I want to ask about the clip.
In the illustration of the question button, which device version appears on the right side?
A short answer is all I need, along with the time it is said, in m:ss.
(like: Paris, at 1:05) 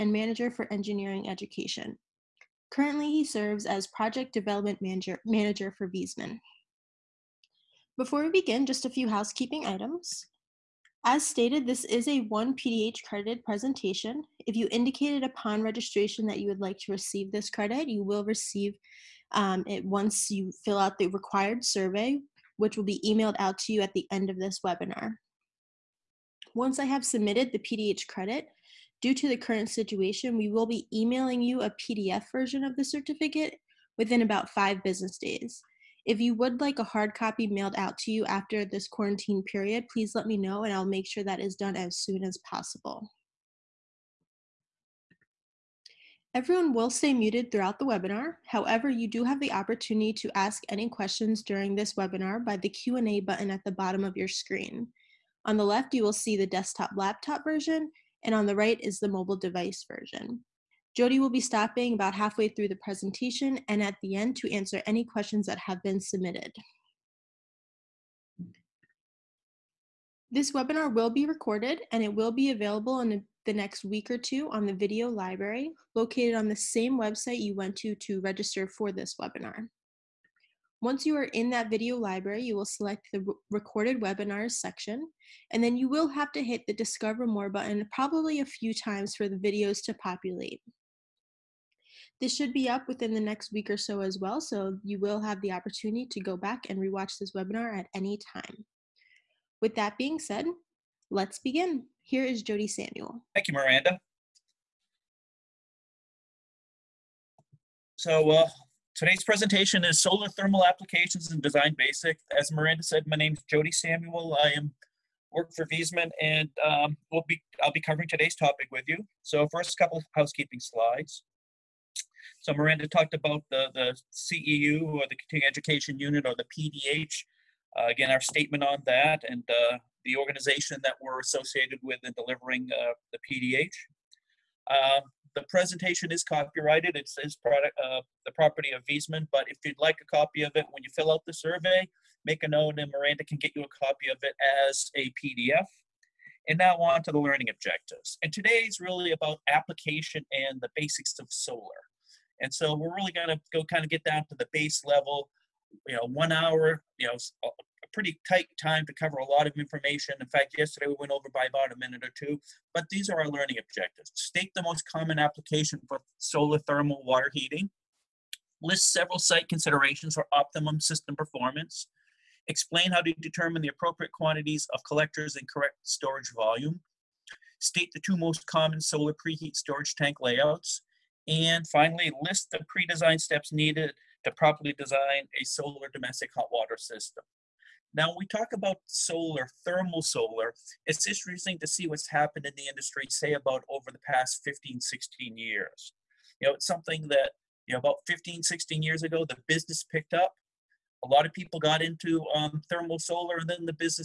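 mobile device version, at 0:59.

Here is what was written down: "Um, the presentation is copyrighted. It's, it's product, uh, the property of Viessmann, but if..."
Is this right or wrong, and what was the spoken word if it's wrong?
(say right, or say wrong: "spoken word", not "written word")
right.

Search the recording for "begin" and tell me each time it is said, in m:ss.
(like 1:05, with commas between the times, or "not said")
0:08, 1:41.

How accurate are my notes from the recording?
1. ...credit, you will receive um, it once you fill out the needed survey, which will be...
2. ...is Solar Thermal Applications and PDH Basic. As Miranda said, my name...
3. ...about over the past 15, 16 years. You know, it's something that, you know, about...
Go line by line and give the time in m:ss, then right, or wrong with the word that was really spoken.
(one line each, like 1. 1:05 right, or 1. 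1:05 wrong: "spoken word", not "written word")
1. 0:17 wrong: "required", not "needed"
2. 1:49 wrong: "Design", not "PDH"
3. 3:13 right.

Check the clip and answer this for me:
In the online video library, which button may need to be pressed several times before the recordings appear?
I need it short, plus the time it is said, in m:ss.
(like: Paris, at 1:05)
discover more, at 1:26.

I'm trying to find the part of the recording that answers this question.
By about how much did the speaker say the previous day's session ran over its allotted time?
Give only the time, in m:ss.
2:41.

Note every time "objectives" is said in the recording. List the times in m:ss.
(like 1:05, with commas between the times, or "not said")
2:27, 2:43.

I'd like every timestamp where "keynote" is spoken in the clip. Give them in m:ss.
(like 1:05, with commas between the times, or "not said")
not said.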